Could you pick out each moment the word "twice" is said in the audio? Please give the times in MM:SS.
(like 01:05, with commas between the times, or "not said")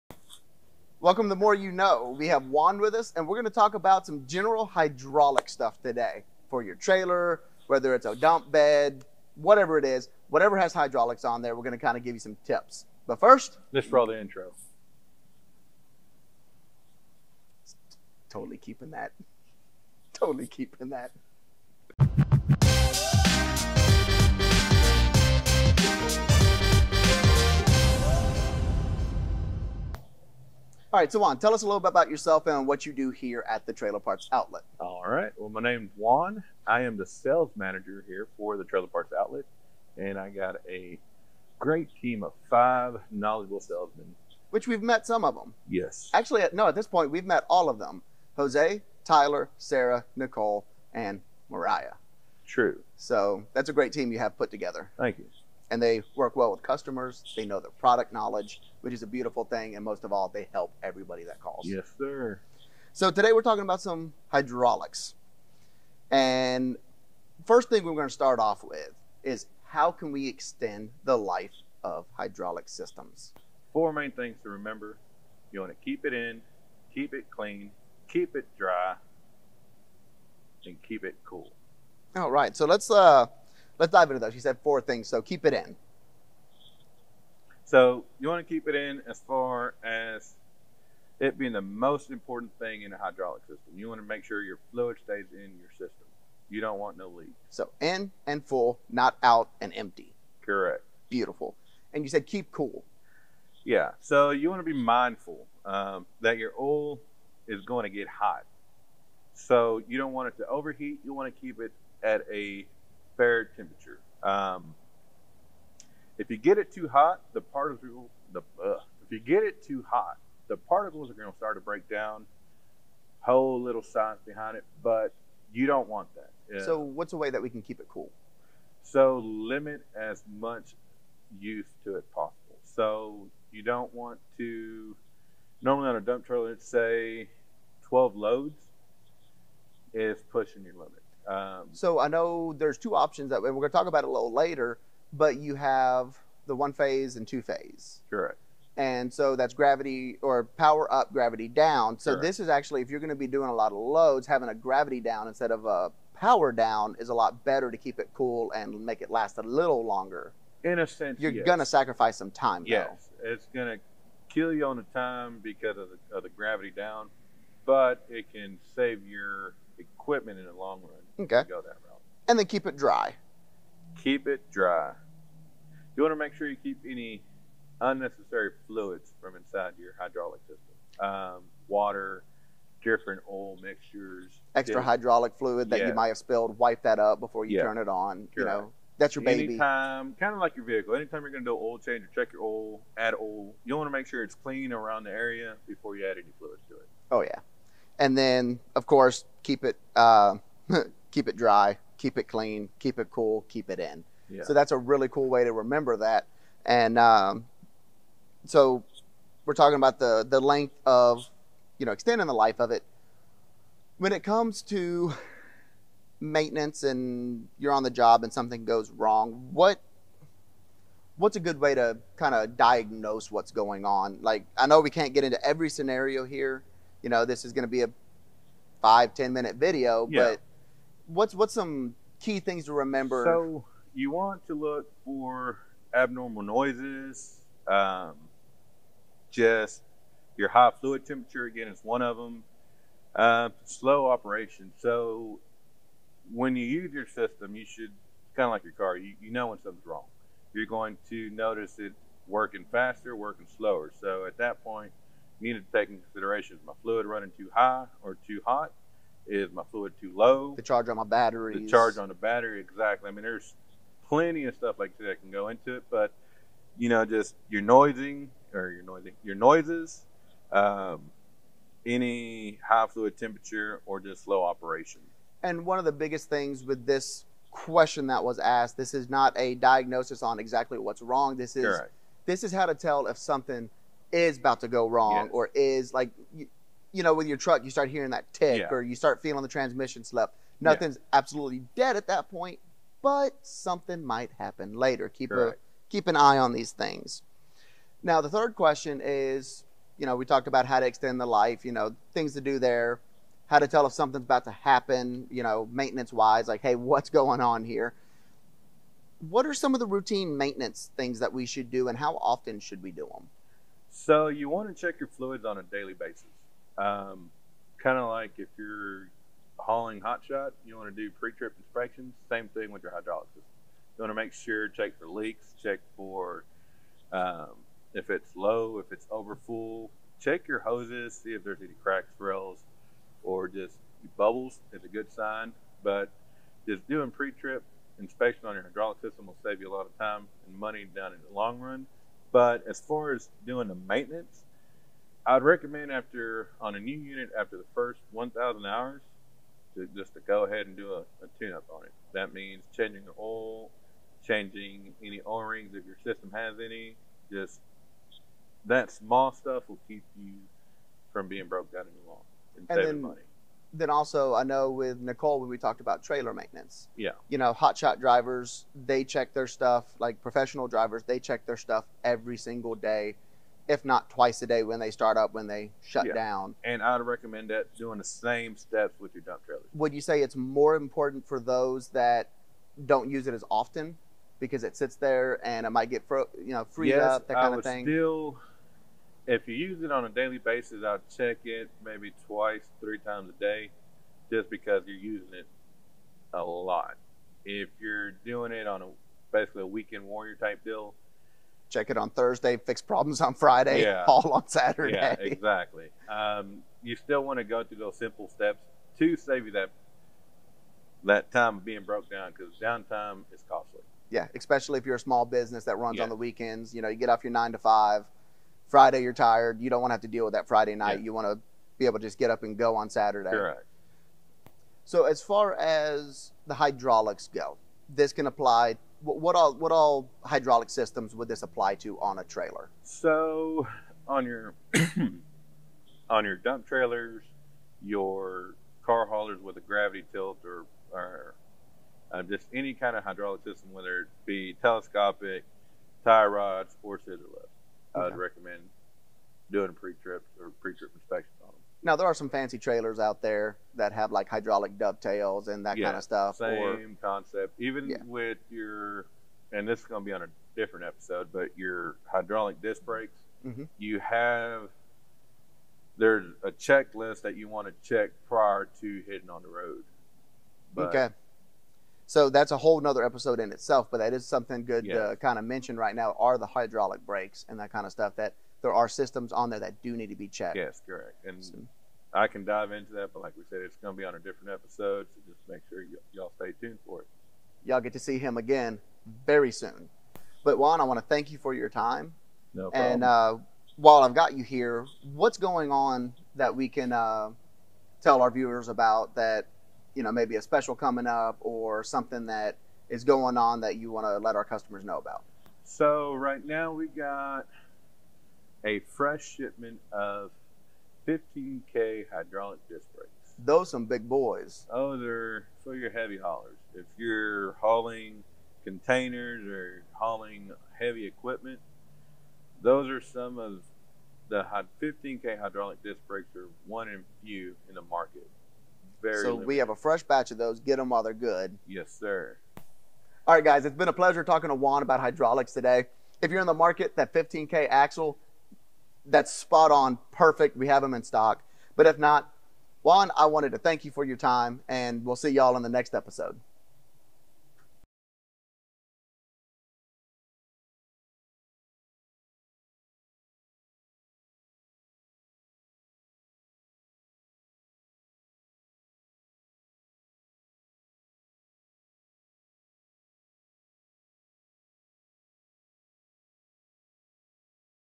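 06:14, 06:32.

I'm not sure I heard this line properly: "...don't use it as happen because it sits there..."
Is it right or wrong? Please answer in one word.
wrong.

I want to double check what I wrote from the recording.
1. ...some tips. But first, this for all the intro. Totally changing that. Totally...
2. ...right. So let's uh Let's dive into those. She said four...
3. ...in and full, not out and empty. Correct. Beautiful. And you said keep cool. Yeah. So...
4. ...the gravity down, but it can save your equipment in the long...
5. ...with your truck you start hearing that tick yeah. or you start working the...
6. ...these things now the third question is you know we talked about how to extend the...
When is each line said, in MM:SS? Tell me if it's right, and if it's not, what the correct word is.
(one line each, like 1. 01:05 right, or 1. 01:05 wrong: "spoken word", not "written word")
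1. 00:12 wrong: "keeping", not "changing"
2. 01:22 right
3. 01:37 right
4. 02:46 right
5. 04:47 wrong: "feeling", not "working"
6. 04:56 right.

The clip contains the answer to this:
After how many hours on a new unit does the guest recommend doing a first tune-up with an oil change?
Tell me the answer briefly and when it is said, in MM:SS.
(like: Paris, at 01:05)
1,000, at 05:48.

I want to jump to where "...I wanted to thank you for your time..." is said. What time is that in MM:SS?
09:03.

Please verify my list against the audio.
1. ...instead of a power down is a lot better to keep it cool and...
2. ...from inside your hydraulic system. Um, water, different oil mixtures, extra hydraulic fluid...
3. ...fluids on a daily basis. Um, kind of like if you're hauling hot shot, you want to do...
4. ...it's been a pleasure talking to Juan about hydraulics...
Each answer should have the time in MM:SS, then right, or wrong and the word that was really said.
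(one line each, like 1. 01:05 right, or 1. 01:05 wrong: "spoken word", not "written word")
1. 02:35 right
2. 02:59 right
3. 05:15 right
4. 08:53 right.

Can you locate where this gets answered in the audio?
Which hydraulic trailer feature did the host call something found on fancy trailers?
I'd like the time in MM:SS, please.
07:34.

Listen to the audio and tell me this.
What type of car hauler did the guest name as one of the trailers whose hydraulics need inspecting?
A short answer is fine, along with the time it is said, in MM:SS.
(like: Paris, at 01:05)
Gravity tilt, at 07:19.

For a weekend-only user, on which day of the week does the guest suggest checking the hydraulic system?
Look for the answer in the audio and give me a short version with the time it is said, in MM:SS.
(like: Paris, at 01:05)
Thursday, at 06:42.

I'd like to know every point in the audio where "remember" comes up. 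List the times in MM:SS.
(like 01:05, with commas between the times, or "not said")
01:14, 03:25, 03:52.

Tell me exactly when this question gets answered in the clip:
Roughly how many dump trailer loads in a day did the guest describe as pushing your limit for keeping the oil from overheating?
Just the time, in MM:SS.
02:17.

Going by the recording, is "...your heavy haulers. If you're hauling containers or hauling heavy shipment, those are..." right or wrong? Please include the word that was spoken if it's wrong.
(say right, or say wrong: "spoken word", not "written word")
wrong: "equipment", not "shipment".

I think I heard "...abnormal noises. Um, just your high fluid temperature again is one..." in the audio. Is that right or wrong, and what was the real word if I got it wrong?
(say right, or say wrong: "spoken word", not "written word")
right.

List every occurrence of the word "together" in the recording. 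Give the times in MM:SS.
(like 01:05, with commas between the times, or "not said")
00:54.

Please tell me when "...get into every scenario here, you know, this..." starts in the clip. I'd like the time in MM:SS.
03:45.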